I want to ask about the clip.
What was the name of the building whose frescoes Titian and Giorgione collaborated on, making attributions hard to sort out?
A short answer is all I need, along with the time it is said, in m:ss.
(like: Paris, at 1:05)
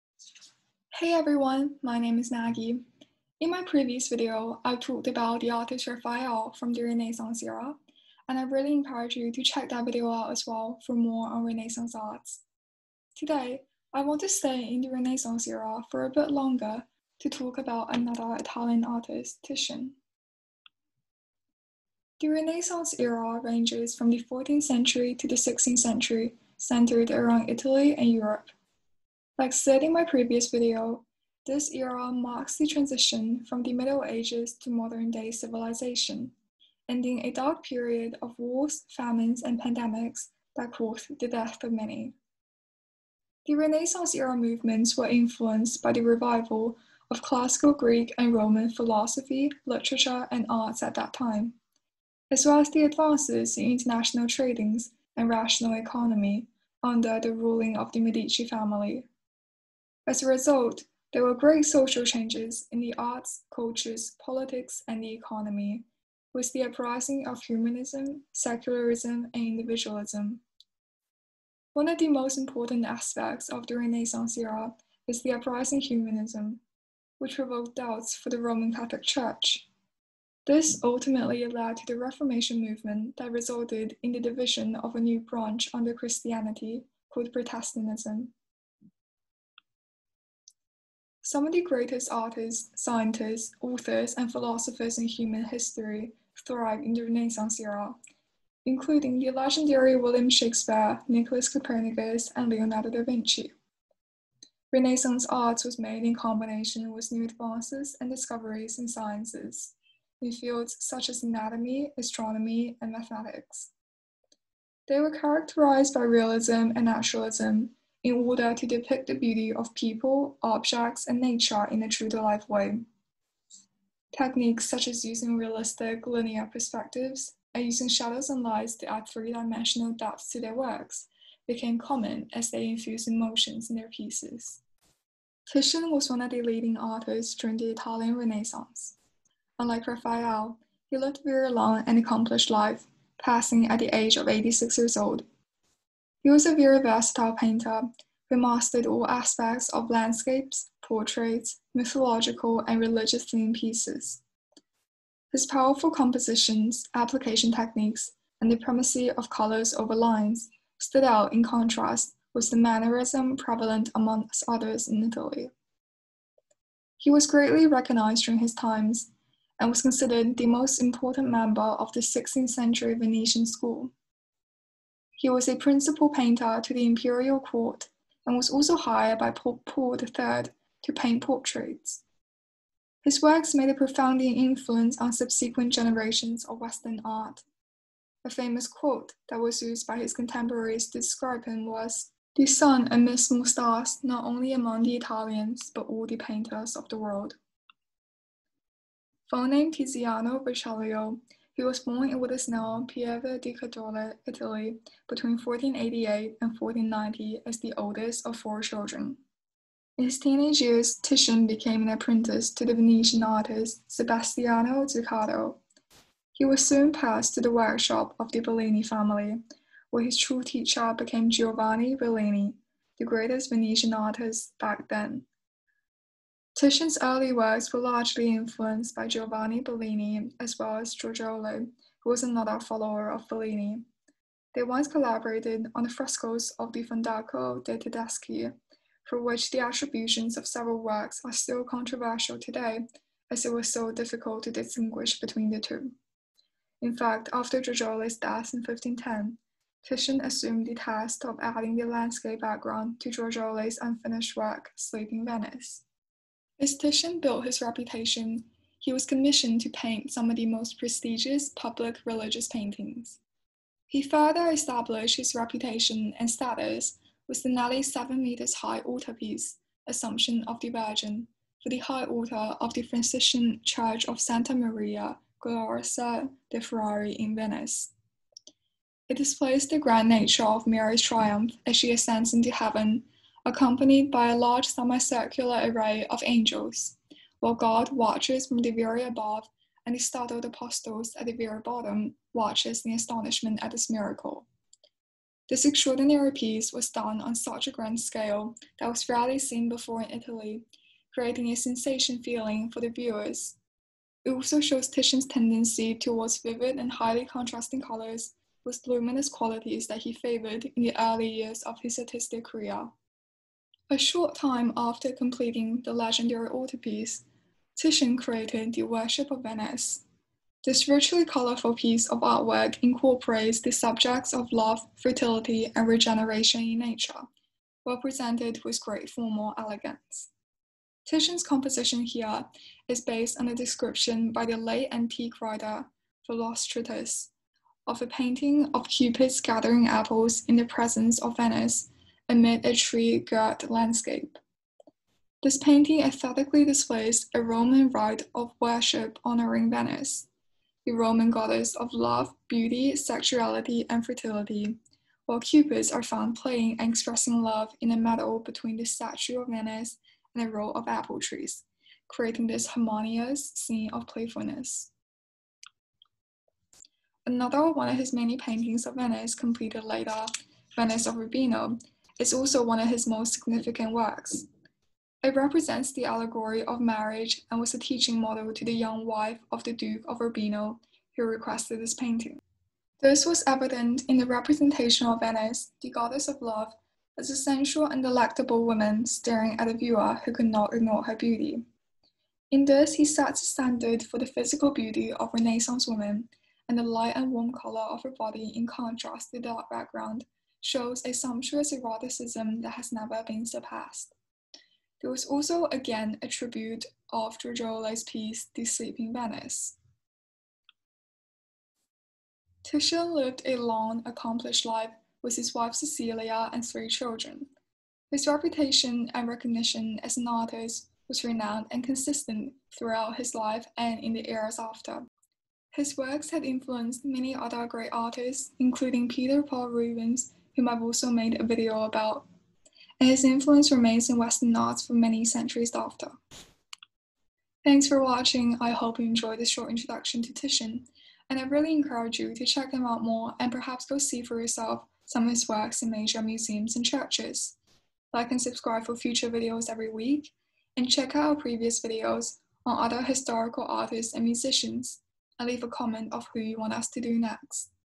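Fondaco de' Tedeschi, at 3:56.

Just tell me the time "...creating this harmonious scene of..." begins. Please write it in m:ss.
6:02.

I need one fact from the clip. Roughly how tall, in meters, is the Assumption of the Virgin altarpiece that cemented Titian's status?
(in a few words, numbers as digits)
7 meters.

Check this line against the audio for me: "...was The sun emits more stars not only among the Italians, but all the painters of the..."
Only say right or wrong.
right.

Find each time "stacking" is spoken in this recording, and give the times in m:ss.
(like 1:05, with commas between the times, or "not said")
not said.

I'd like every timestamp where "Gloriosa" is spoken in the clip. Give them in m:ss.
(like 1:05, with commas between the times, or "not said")
4:35.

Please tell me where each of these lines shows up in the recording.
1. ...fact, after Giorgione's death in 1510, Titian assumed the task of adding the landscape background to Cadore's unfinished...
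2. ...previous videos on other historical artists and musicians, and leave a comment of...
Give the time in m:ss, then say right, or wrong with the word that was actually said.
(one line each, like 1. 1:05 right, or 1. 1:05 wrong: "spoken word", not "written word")
1. 4:06 wrong: "Giorgione", not "Cadore"
2. 7:31 right.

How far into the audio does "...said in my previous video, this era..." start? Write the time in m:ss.
0:29.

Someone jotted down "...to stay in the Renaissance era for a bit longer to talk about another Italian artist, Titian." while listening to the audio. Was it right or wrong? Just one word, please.
right.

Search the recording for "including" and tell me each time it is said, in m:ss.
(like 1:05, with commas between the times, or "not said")
1:38, 7:08.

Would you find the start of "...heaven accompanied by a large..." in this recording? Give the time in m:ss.
4:42.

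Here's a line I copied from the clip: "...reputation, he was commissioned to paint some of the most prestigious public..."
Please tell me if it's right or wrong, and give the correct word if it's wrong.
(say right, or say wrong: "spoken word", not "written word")
right.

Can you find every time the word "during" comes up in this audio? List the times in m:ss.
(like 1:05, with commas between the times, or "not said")
2:17, 2:48.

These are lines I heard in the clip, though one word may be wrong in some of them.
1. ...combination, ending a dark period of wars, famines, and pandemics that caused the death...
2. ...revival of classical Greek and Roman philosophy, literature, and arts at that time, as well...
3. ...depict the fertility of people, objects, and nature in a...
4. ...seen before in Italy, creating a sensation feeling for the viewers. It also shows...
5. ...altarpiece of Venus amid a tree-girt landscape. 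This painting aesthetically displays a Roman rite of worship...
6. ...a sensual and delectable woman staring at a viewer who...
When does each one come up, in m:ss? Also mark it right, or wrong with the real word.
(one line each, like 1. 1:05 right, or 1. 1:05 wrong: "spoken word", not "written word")
1. 0:35 wrong: "civilization", not "combination"
2. 0:46 right
3. 1:58 wrong: "beauty", not "fertility"
4. 4:59 right
5. 5:40 wrong: "presence", not "altarpiece"
6. 6:27 right.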